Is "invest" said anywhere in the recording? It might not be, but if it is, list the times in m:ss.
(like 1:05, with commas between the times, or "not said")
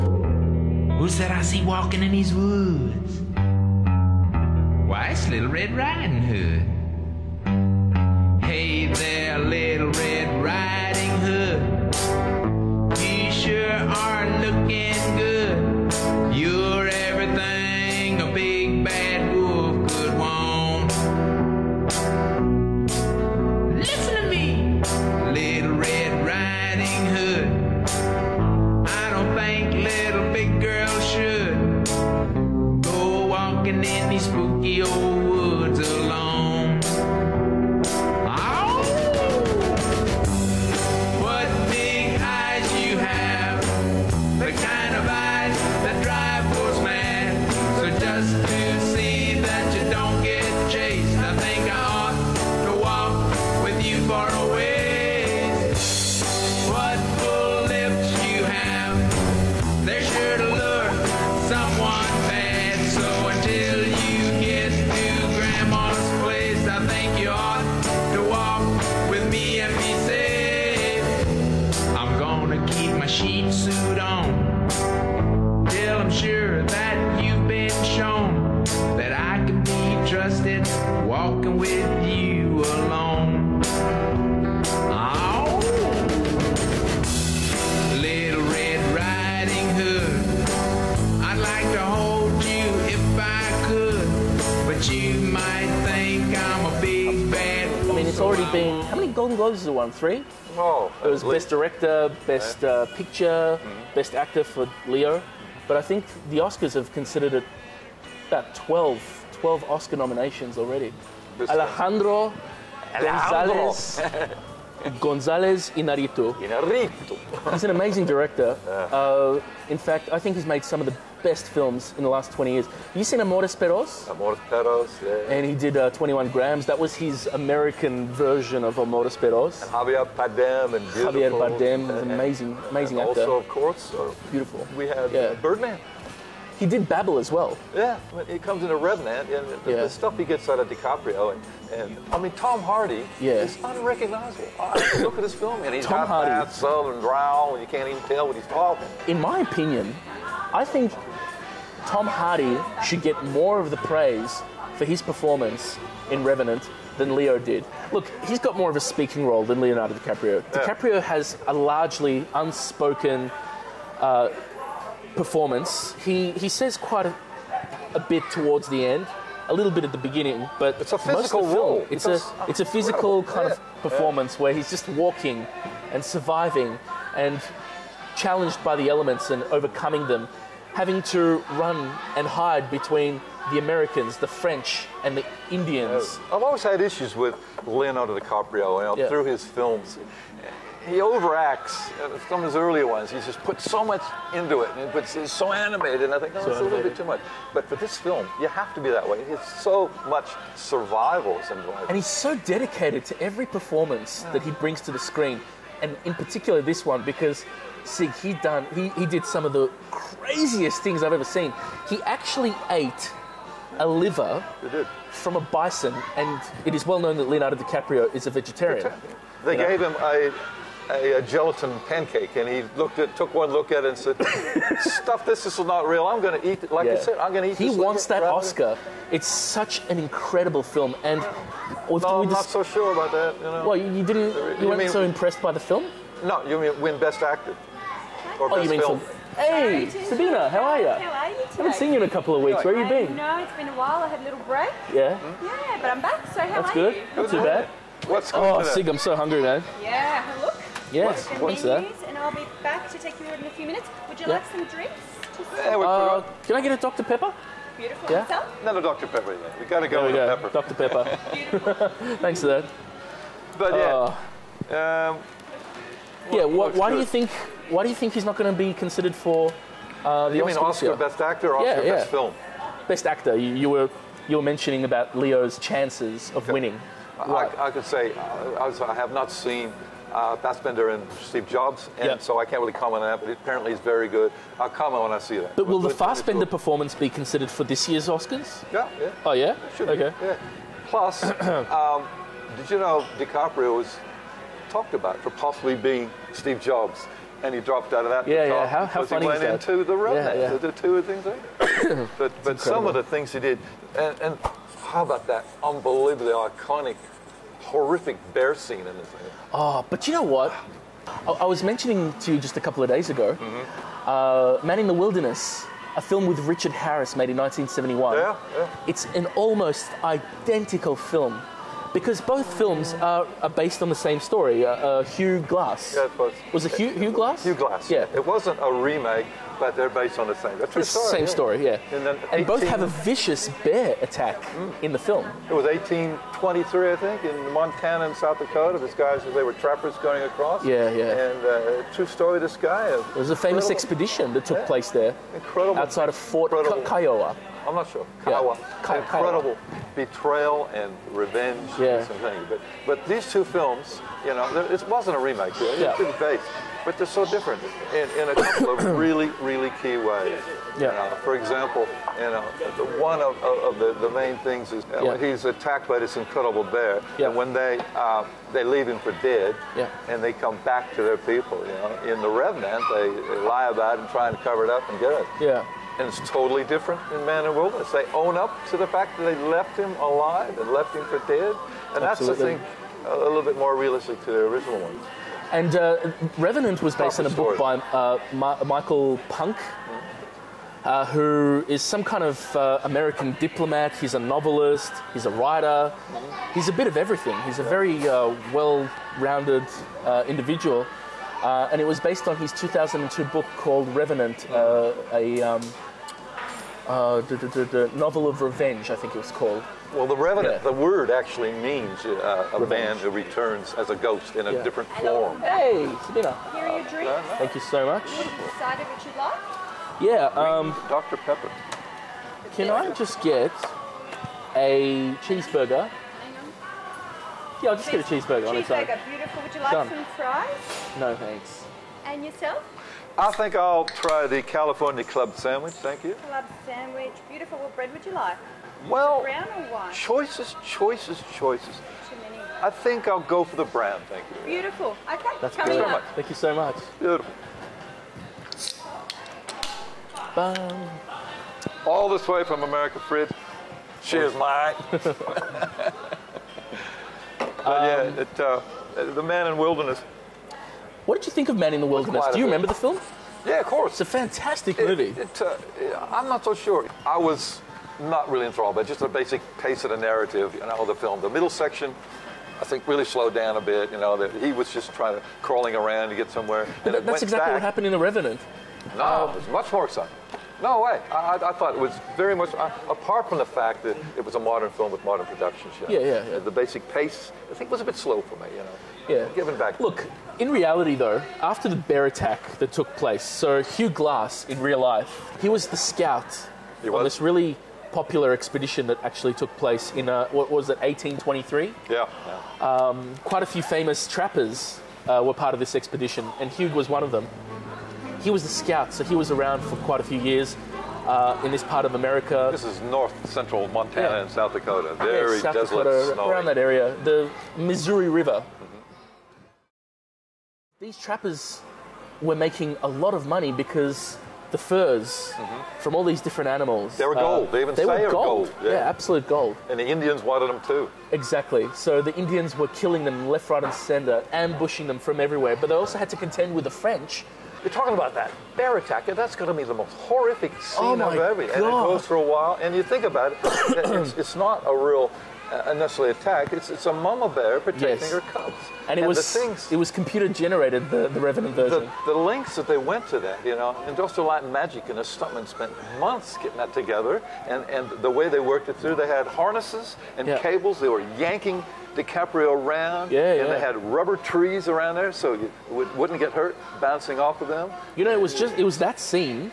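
not said.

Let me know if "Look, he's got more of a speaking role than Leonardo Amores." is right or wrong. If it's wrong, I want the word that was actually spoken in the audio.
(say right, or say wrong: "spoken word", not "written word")
wrong: "DiCaprio", not "Amores".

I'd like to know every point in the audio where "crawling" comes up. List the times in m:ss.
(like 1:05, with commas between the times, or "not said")
7:55.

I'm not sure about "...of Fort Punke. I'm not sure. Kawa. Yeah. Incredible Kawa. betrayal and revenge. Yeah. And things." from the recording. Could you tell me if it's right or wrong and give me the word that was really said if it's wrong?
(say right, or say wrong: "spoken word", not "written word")
wrong: "Kiowa", not "Punke".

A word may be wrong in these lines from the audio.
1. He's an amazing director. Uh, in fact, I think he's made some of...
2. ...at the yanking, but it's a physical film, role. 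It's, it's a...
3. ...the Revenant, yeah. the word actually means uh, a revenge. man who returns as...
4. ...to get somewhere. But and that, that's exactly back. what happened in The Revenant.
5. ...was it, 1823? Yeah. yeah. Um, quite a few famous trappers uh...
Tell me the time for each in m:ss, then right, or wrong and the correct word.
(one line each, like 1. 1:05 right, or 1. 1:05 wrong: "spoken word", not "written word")
1. 1:57 right
2. 2:49 wrong: "beginning", not "yanking"
3. 6:50 right
4. 7:56 right
5. 8:20 right.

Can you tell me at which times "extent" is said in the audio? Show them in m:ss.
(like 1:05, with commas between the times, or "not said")
not said.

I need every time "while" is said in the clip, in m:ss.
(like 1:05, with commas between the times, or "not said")
4:03, 9:02.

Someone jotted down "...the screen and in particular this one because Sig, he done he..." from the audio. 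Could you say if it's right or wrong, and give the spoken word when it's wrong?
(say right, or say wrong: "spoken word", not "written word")
right.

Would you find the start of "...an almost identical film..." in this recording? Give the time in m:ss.
5:19.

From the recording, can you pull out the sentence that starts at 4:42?
so I can't really comment on that, but it apparently it's very good.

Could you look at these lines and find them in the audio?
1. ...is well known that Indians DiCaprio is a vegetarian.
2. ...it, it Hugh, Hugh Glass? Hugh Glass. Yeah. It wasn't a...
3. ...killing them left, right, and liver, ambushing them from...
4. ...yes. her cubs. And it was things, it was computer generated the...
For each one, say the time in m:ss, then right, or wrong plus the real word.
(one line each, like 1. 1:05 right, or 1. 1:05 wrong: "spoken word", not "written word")
1. 3:36 wrong: "Leonardo", not "Indians"
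2. 5:26 right
3. 8:52 wrong: "center", not "liver"
4. 9:07 right.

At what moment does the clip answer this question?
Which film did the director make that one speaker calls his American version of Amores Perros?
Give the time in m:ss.
2:05.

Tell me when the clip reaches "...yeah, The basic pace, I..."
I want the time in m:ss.
8:05.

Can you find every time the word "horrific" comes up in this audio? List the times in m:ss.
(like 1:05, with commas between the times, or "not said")
5:07, 8:59.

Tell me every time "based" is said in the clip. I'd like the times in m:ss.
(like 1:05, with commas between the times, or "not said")
5:23, 5:29, 5:56, 6:26, 6:41.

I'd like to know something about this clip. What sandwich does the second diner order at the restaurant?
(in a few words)
California club sandwich.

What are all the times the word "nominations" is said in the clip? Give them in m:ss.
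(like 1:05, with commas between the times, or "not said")
1:49.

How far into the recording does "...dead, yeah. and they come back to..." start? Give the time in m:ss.
6:09.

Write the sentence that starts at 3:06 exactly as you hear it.
Uh, I've always had issues with Leonardo DiCaprio you know, yeah.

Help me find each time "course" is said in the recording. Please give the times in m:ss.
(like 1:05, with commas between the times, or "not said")
2:13, 7:43.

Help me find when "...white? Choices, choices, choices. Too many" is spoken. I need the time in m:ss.
7:19.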